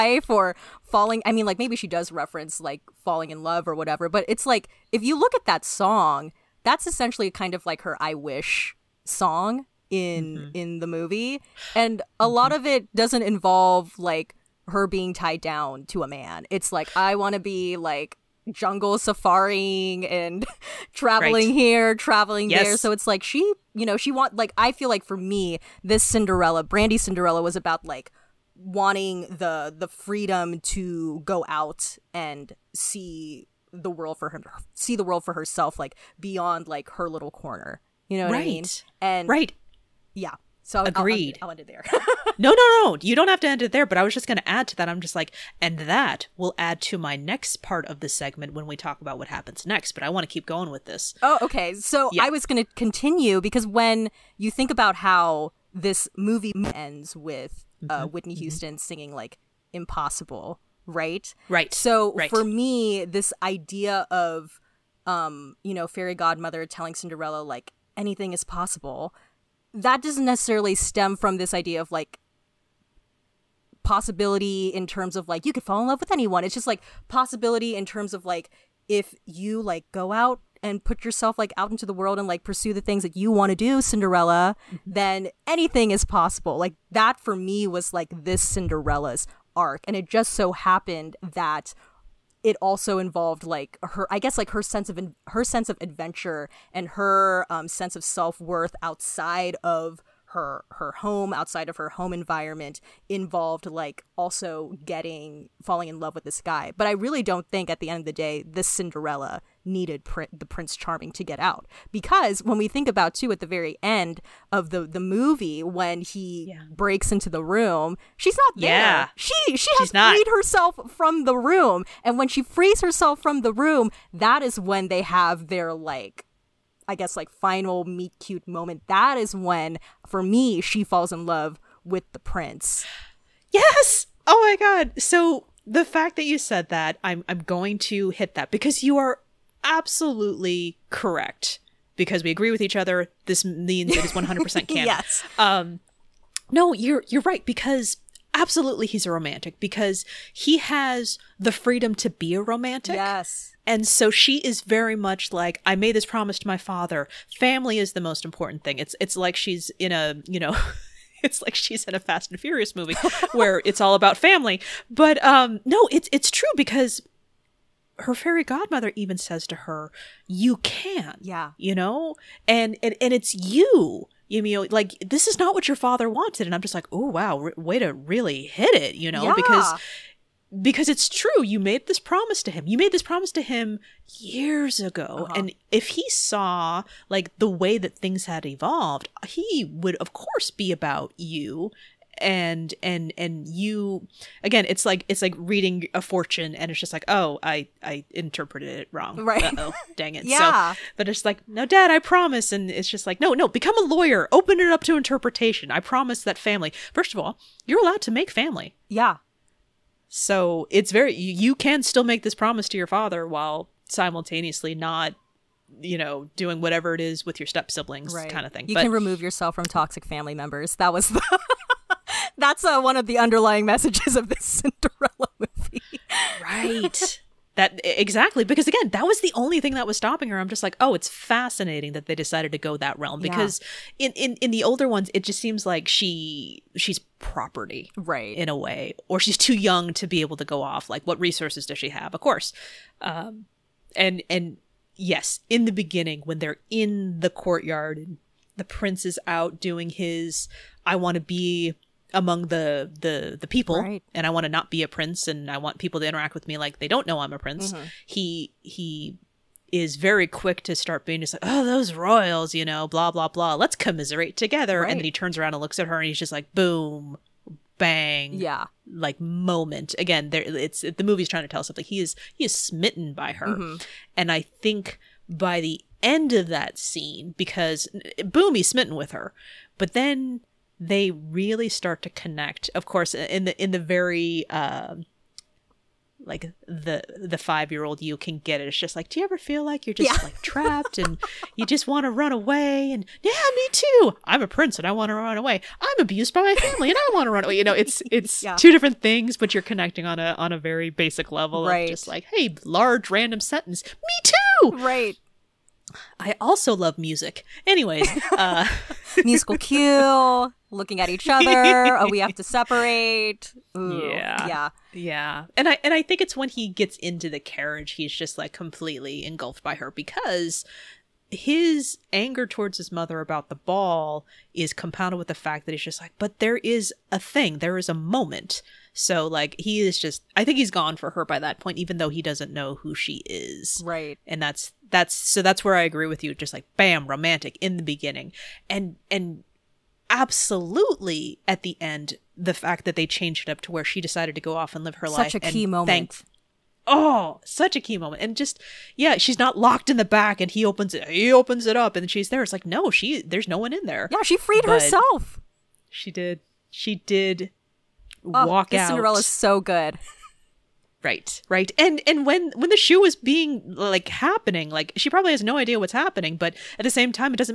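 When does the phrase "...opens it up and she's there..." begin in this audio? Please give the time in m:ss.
5:51.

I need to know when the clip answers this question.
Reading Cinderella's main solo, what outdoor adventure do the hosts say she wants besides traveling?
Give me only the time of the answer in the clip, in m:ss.
0:18.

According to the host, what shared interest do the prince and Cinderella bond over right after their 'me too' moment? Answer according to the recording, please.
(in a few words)
music.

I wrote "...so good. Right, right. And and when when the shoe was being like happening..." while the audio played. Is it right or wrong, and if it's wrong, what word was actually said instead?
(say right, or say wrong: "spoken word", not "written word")
right.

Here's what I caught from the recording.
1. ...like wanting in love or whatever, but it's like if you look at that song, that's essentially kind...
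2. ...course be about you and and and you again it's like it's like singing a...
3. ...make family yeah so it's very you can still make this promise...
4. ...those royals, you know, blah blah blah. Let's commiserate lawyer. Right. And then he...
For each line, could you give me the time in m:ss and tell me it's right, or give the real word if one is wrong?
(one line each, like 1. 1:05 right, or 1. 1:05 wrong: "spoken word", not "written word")
1. 0:02 wrong: "falling", not "wanting"
2. 3:10 wrong: "reading", not "singing"
3. 3:28 right
4. 4:21 wrong: "together", not "lawyer".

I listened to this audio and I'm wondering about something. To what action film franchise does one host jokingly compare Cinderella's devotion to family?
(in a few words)
Fast and Furious.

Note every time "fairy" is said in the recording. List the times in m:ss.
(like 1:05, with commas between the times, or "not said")
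1:05, 2:48.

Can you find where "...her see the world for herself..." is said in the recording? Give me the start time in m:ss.
0:34.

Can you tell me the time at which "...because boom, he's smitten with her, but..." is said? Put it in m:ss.
4:37.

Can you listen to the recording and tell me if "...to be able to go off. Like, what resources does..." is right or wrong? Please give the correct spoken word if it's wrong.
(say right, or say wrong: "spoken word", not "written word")
right.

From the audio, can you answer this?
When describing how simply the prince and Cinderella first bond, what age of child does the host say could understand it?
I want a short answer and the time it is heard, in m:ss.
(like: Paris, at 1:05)
5, at 4:47.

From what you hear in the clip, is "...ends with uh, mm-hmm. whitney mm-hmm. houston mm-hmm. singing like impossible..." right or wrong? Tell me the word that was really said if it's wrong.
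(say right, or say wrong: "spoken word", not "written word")
right.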